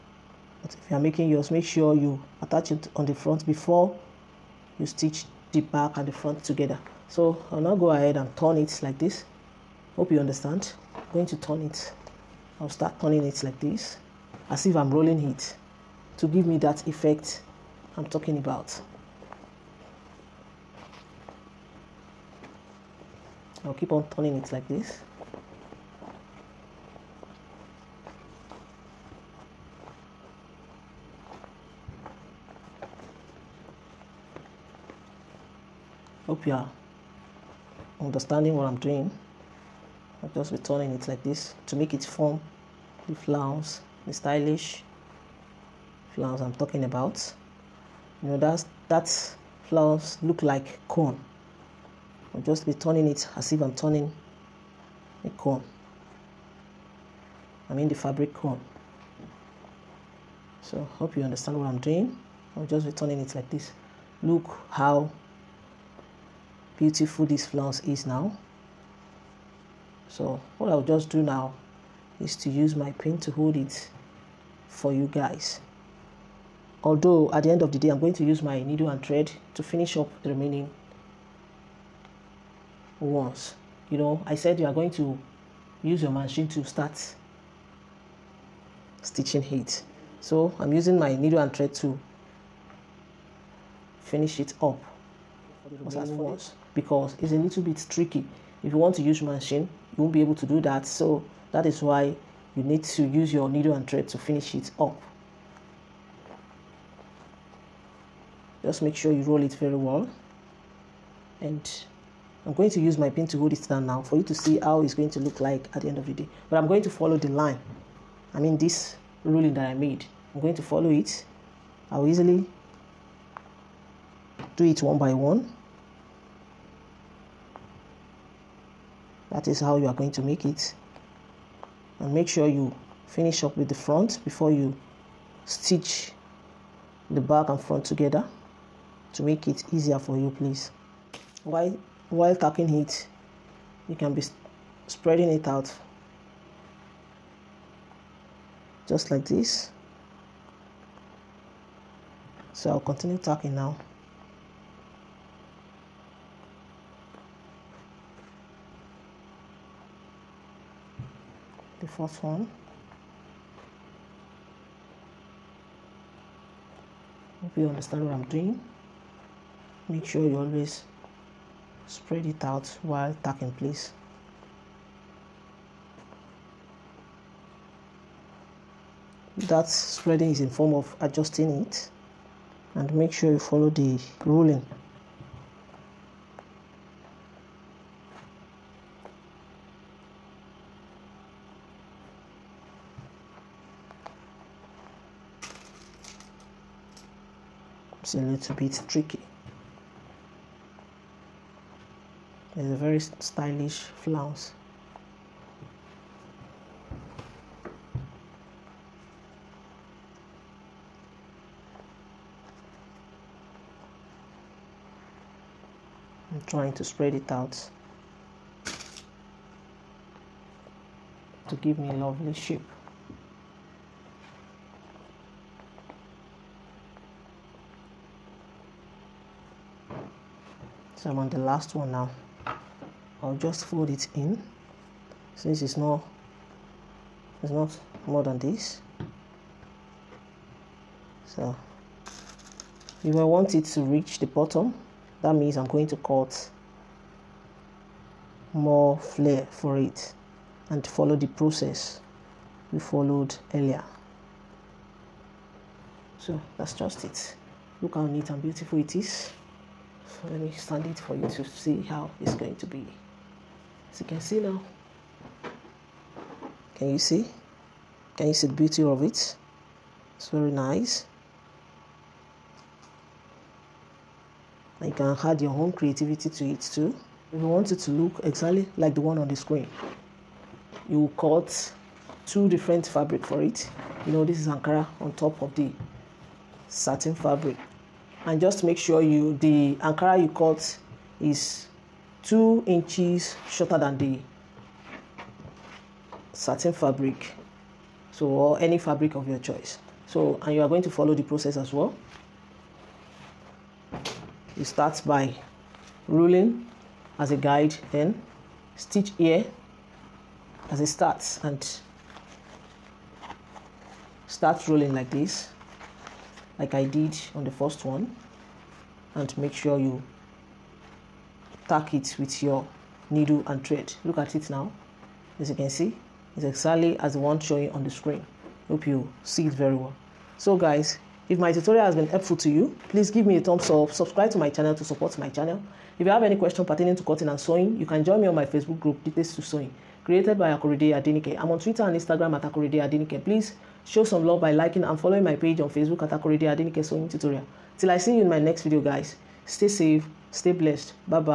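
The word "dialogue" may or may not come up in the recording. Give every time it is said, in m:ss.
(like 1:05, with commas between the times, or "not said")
not said.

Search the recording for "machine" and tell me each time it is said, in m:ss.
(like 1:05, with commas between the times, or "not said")
1:26, 1:39.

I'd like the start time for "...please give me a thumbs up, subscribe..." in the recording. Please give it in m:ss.
5:32.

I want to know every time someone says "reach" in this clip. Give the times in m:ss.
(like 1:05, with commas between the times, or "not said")
4:03.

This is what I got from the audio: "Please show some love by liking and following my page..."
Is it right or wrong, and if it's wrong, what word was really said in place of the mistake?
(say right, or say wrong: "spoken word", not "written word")
right.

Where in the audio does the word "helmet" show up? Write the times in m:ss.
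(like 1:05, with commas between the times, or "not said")
not said.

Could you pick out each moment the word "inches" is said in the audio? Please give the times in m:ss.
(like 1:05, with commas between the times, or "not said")
4:52.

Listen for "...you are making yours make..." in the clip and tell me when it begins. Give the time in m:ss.
0:00.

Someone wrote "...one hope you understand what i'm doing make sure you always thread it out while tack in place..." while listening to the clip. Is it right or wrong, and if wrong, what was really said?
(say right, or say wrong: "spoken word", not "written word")
wrong: "spread", not "thread".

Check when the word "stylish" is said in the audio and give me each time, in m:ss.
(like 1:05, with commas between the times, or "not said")
0:44, 3:22.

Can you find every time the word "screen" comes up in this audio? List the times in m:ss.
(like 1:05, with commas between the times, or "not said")
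4:39, 5:27.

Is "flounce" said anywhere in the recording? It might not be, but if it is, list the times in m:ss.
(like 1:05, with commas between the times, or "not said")
1:07, 3:23.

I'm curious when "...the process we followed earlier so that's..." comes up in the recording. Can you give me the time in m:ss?
4:11.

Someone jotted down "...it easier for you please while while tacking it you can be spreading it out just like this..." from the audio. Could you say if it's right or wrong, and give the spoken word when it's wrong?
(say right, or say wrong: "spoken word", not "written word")
right.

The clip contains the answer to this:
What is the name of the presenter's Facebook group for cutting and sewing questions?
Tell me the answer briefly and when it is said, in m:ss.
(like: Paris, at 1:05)
Details to Sewing, at 5:39.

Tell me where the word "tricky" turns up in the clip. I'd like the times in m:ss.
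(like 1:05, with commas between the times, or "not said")
1:37, 3:18.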